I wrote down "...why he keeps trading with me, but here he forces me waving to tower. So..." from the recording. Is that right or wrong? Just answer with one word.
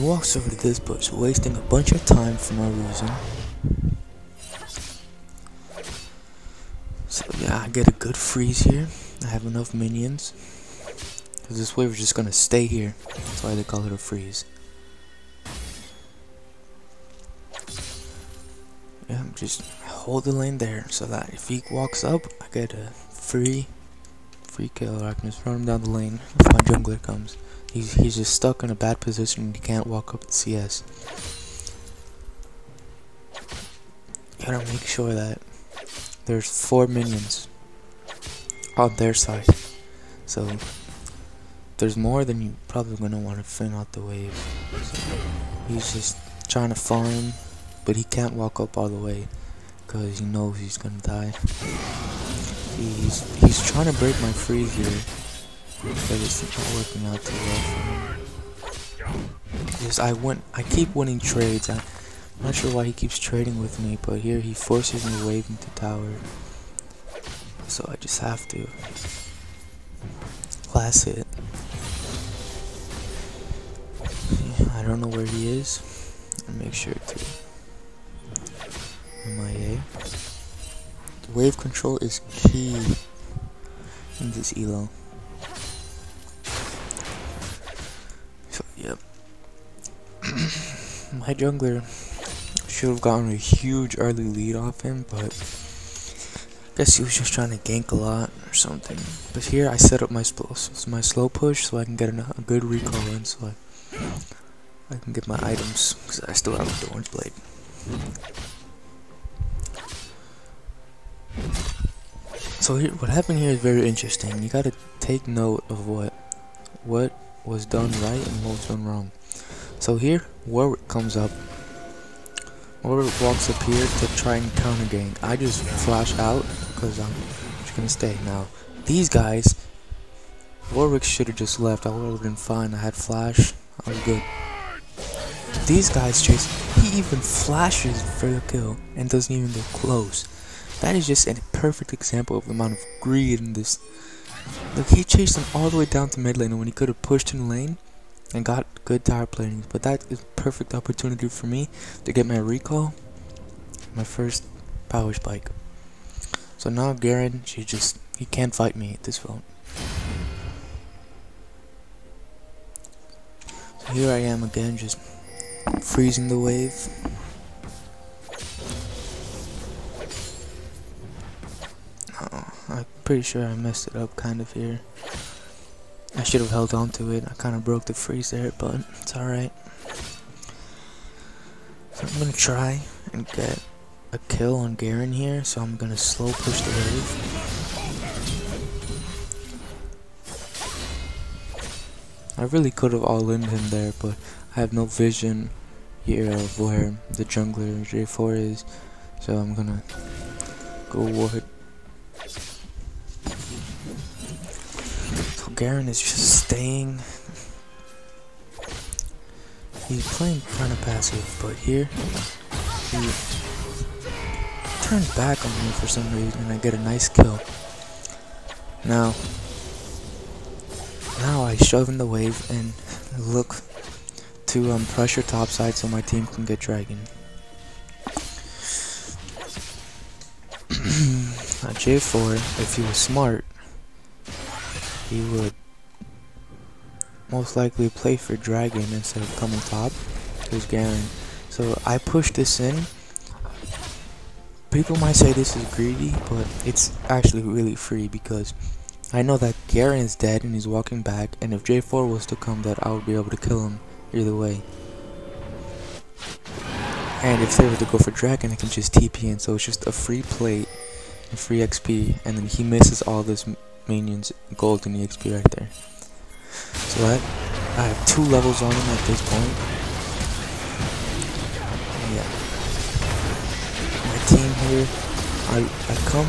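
right.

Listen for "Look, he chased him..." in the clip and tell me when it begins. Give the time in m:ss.
2:24.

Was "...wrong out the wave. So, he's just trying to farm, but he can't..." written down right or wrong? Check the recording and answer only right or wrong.
wrong.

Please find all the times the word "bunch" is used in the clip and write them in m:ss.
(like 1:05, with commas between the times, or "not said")
0:01.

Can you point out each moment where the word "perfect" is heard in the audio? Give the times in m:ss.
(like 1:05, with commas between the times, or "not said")
2:21, 2:30.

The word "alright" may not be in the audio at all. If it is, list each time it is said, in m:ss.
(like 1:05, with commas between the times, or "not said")
2:59.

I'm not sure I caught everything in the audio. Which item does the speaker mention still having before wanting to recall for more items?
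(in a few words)
Orange blade.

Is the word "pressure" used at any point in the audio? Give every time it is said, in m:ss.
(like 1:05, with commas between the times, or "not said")
3:44.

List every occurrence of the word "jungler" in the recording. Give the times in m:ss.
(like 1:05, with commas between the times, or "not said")
0:26, 1:31, 3:17.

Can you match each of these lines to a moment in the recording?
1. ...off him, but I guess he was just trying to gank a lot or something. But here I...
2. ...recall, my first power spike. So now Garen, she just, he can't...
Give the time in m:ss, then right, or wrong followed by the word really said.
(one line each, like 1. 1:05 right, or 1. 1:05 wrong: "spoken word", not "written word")
1. 1:34 right
2. 2:32 right.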